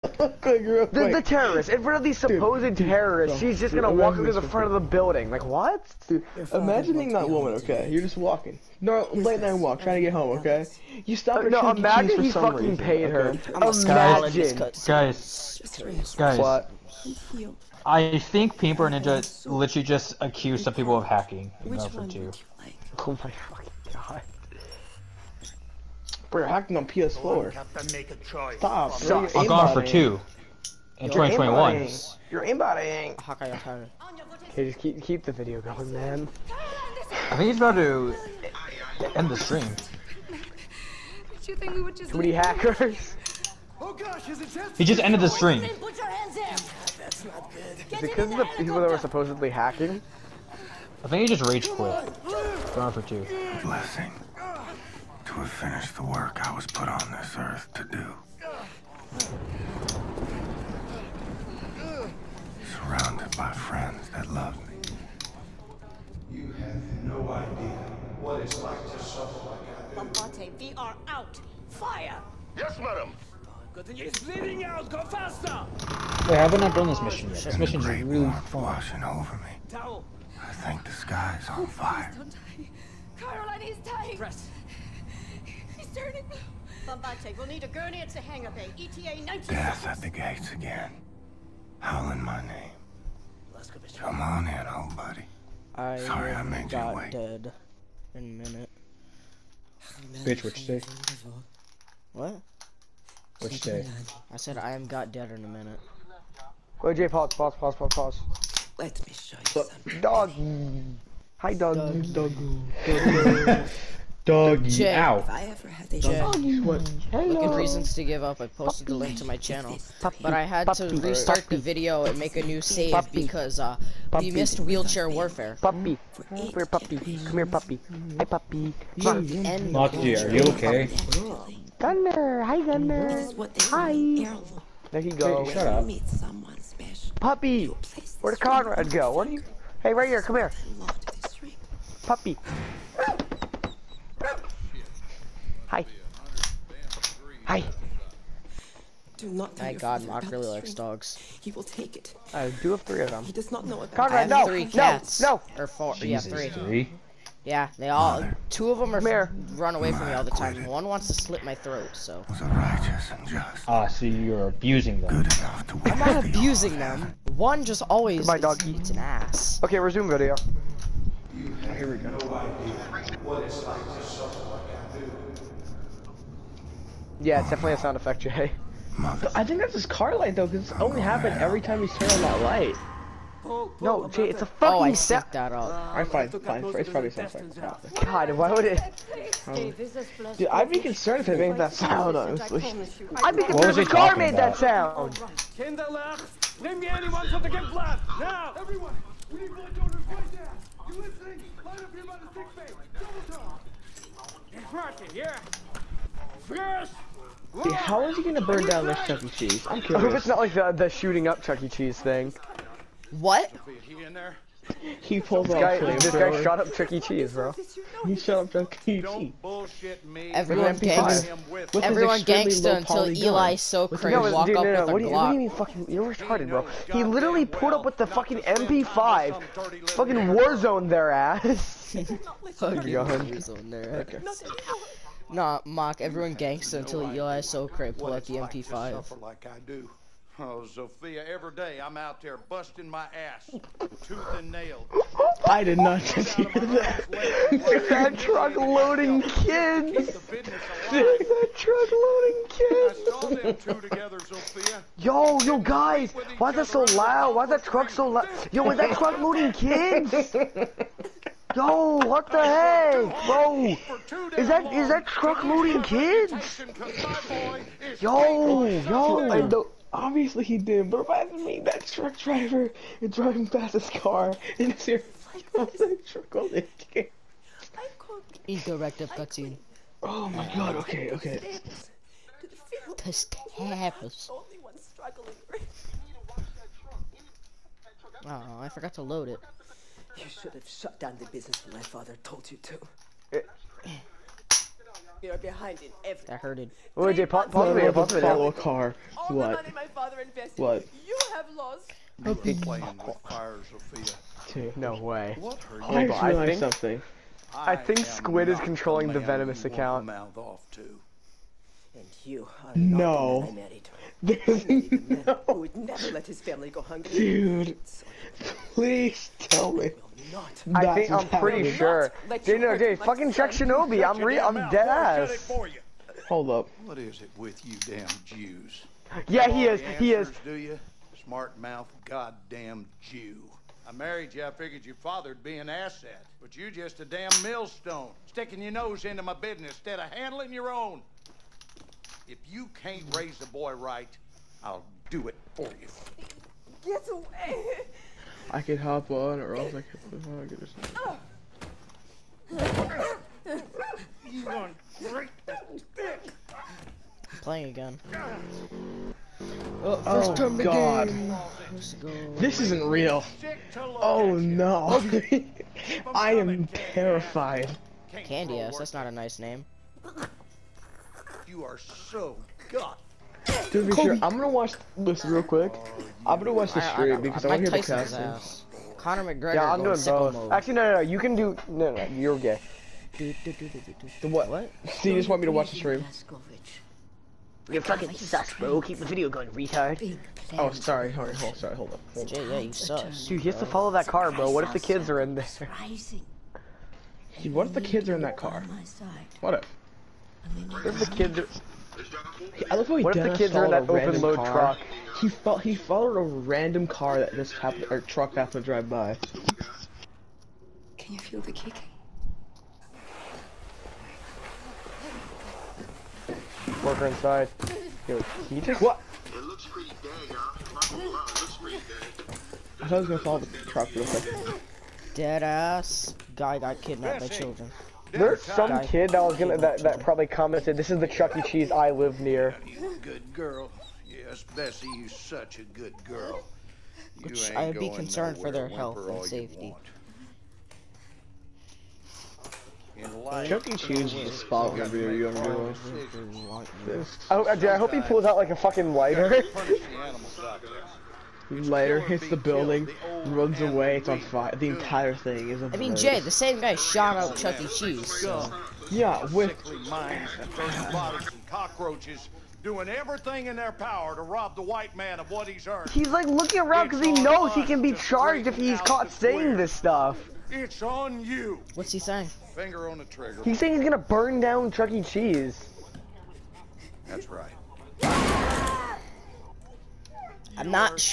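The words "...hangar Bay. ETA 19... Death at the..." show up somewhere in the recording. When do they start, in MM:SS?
01:28.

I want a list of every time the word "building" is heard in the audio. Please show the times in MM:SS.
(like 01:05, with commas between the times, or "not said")
00:04, 07:32.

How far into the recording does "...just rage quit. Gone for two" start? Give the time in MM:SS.
00:51.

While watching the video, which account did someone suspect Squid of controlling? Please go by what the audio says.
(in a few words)
Venomous.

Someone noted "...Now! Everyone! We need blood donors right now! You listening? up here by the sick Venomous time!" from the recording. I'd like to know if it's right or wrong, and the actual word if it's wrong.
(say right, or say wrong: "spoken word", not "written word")
wrong: "Double", not "Venomous".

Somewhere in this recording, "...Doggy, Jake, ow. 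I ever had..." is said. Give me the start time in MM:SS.
01:54.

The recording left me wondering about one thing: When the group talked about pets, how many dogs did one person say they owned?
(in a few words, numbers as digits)
3.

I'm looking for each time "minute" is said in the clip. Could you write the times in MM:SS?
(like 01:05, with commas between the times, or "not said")
01:38, 01:45.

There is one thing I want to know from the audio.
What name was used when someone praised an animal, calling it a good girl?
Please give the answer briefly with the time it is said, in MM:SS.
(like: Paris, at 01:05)
Bessie, at 07:14.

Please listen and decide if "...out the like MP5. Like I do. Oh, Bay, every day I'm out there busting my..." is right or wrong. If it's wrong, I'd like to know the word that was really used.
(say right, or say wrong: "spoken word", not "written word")
wrong: "Sophia", not "Bay".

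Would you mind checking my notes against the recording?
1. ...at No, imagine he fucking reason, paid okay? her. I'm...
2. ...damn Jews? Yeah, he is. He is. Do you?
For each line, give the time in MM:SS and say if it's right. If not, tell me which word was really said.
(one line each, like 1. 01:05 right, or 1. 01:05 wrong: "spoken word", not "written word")
1. 00:11 right
2. 05:27 right.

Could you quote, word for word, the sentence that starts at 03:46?
He literally pulled up with the fucking MP5, fucking Warzone their ass.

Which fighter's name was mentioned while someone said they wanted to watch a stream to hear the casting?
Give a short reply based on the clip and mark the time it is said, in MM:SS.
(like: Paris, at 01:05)
Conor McGregor, at 06:18.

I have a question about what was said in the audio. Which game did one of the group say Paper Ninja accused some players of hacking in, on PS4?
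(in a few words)
Battlefield 2.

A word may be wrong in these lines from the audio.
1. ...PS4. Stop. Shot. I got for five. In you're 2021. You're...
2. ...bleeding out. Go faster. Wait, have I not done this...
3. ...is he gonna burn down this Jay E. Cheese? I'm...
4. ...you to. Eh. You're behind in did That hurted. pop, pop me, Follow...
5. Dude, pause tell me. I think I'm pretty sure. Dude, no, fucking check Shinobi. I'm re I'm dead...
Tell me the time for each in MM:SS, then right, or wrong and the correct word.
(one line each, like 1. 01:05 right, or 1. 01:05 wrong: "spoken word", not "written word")
1. 00:26 wrong: "two", not "five"
2. 01:14 right
3. 03:28 wrong: "Chuck", not "Jay"
4. 04:52 right
5. 05:17 wrong: "please", not "pause".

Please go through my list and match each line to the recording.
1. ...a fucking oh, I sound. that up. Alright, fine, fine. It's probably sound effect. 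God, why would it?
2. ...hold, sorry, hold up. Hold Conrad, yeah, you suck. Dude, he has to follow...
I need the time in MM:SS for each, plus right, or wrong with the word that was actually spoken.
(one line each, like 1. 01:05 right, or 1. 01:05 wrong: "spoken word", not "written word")
1. 03:04 right
2. 06:31 wrong: "Jay", not "Conrad".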